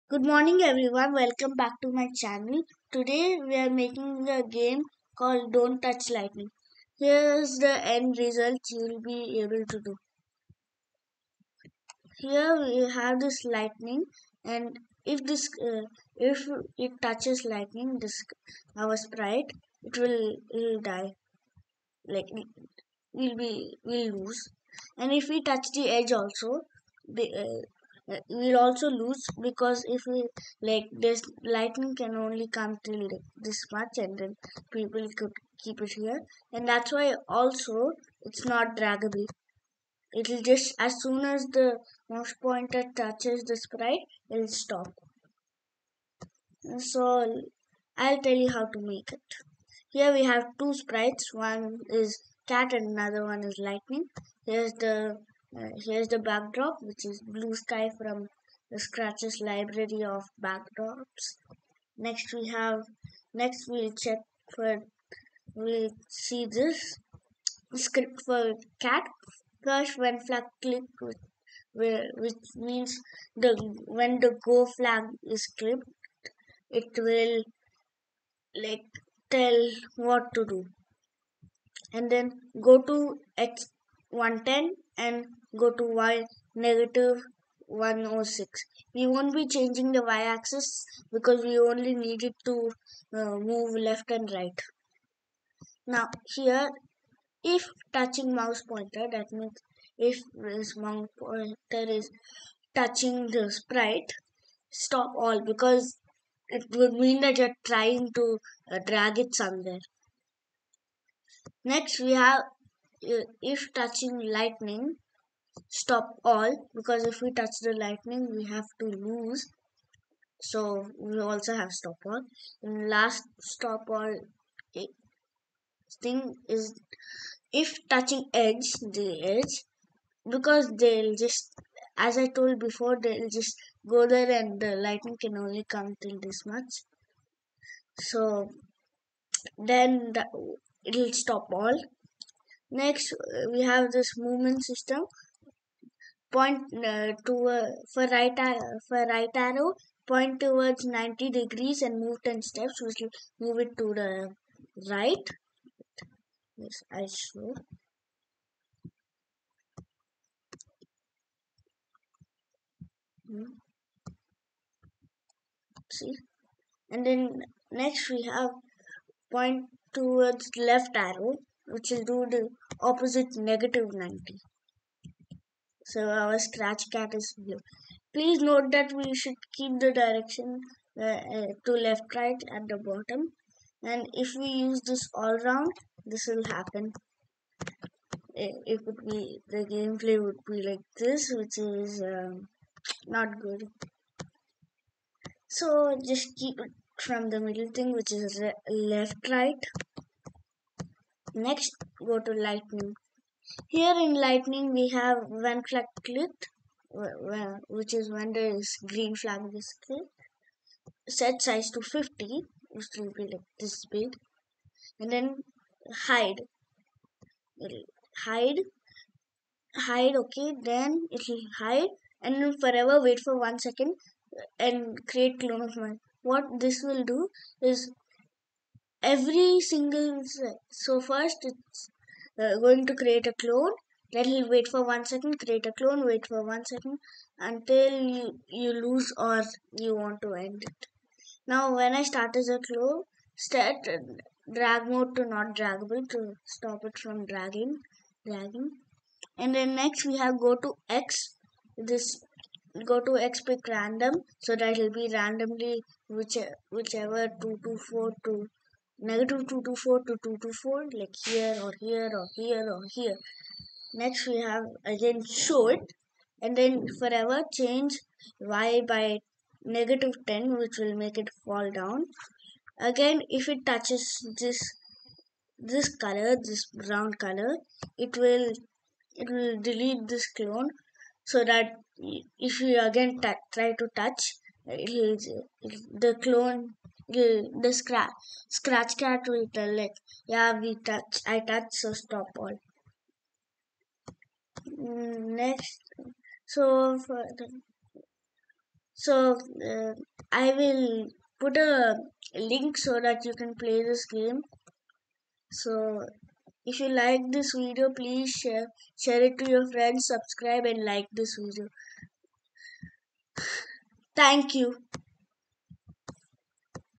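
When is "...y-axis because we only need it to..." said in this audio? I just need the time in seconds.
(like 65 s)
90 s.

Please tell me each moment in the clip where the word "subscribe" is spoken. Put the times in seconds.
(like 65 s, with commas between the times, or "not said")
310 s.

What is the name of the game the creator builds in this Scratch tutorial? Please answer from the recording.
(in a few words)
Don't Touch Lightning.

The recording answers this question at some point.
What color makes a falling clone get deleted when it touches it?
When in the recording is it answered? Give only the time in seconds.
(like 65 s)
276 s.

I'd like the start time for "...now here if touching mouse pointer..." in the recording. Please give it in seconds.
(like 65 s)
95 s.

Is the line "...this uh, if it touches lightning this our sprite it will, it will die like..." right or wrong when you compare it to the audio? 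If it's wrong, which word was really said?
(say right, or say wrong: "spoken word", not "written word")
right.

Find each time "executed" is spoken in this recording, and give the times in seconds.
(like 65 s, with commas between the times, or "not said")
not said.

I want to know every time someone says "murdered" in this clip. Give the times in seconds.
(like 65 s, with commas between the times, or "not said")
not said.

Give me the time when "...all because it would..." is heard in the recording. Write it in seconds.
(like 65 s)
105 s.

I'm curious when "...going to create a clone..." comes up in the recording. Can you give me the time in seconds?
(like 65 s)
232 s.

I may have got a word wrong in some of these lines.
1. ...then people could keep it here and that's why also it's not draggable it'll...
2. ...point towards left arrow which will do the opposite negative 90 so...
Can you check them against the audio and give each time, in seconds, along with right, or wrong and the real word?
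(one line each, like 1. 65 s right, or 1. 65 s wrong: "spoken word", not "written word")
1. 34 s right
2. 169 s right.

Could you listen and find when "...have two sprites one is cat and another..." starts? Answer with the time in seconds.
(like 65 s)
50 s.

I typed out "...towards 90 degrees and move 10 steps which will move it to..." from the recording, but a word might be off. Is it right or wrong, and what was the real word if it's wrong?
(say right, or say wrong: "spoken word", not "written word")
right.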